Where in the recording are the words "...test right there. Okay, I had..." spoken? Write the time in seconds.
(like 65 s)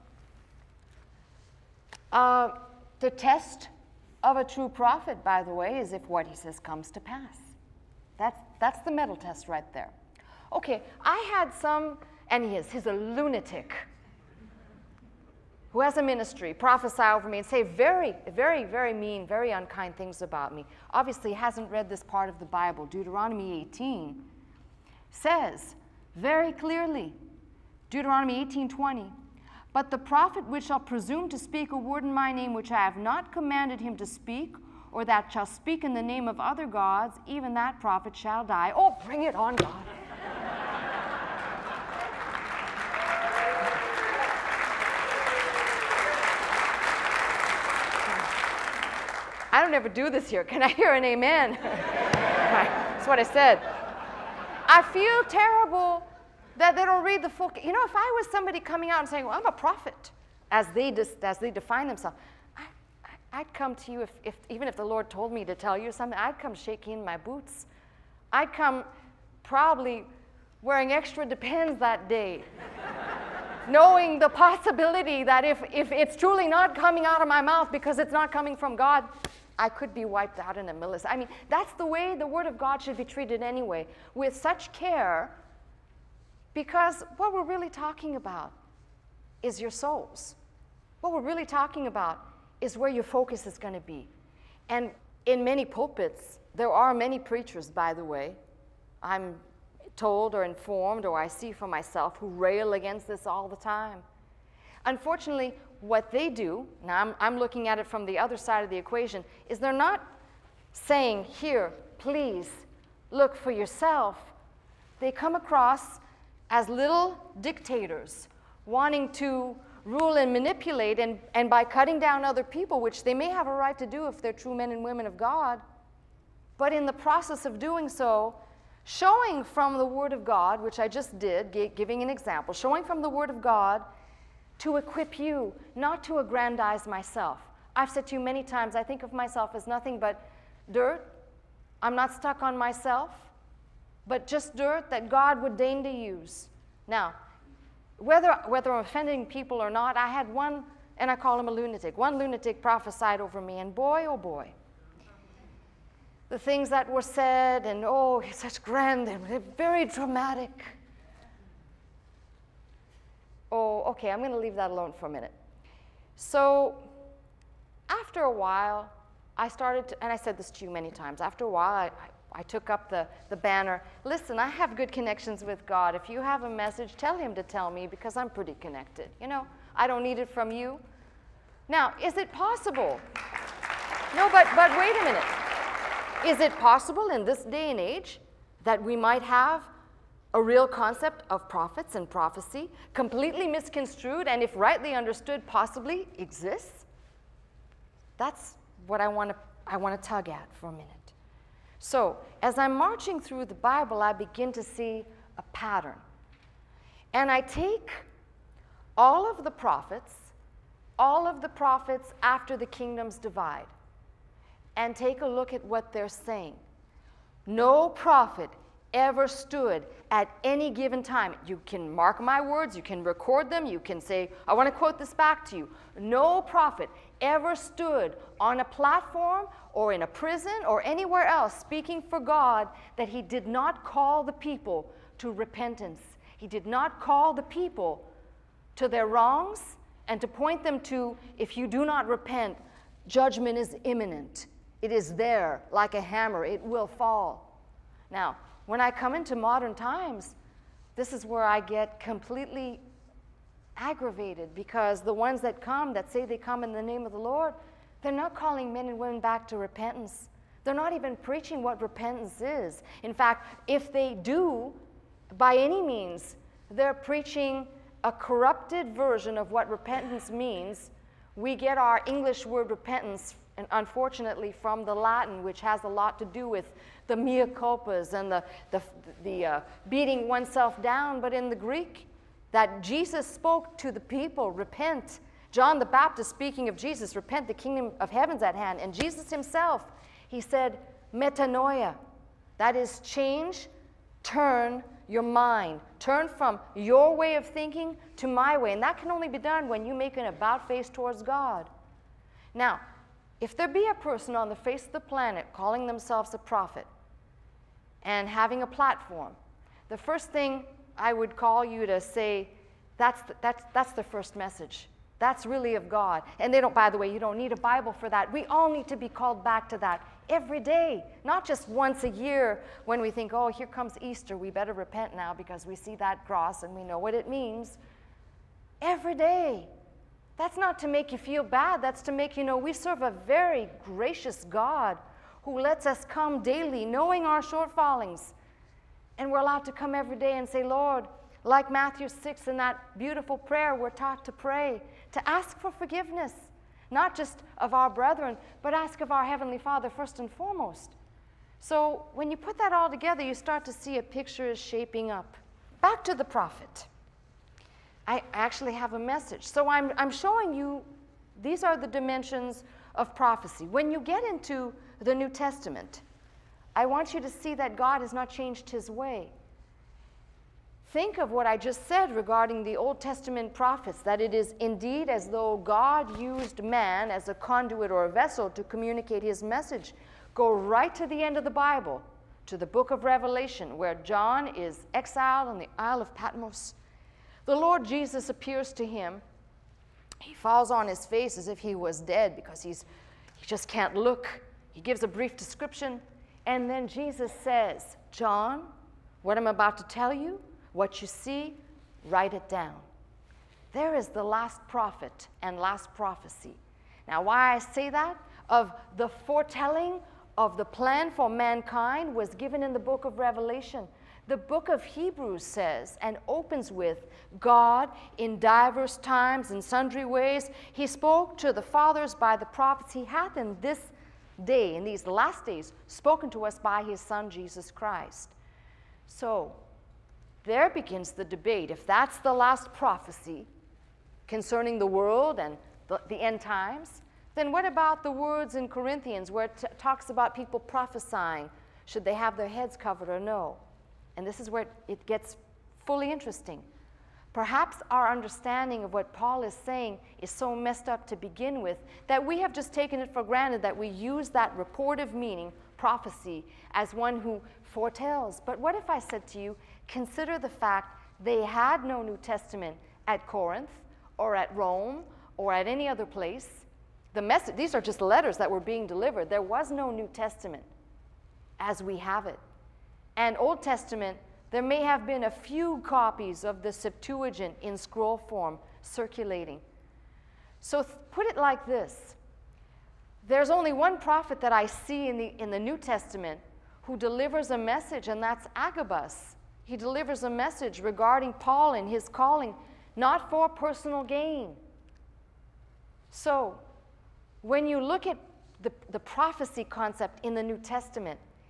9 s.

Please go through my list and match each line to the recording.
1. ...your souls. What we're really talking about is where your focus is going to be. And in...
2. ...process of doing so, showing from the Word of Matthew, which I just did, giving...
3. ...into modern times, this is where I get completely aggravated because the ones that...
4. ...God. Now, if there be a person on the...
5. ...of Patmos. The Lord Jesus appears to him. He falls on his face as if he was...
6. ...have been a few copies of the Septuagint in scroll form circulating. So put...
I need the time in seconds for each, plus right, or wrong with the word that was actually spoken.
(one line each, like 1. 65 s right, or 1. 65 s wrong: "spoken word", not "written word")
1. 89 s right
2. 126 s wrong: "God", not "Matthew"
3. 249 s right
4. 301 s right
5. 386 s right
6. 474 s right.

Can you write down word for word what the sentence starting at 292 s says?
That is, change, turn your mind.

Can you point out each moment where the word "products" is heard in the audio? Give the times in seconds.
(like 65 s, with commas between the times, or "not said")
not said.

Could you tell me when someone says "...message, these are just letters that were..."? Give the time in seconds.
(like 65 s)
467 s.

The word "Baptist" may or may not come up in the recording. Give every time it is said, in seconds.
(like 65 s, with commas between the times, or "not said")
285 s.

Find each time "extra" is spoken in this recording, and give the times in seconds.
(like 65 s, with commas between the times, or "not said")
70 s.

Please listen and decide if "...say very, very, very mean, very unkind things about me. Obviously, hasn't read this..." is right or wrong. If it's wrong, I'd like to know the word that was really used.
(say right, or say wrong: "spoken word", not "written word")
right.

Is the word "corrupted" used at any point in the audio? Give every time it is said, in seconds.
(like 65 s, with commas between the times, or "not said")
268 s.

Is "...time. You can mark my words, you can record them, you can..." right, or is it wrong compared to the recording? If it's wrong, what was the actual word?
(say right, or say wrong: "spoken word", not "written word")
right.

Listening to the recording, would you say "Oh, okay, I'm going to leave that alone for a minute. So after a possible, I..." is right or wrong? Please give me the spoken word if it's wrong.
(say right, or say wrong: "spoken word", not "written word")
wrong: "while", not "possible".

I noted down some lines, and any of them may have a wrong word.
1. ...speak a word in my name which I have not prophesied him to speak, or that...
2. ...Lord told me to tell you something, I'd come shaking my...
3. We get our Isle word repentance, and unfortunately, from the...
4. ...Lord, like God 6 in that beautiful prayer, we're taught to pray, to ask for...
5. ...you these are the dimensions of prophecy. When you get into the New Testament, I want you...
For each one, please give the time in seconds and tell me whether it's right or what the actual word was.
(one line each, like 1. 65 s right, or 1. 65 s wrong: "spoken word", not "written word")
1. 31 s wrong: "commanded", not "prophesied"
2. 64 s right
3. 271 s wrong: "English", not "Isle"
4. 340 s wrong: "Matthew", not "God"
5. 360 s right.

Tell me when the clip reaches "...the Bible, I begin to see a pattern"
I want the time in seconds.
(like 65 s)
203 s.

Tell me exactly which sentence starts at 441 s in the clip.
Should they have their heads covered or no?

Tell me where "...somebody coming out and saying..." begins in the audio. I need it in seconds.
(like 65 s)
58 s.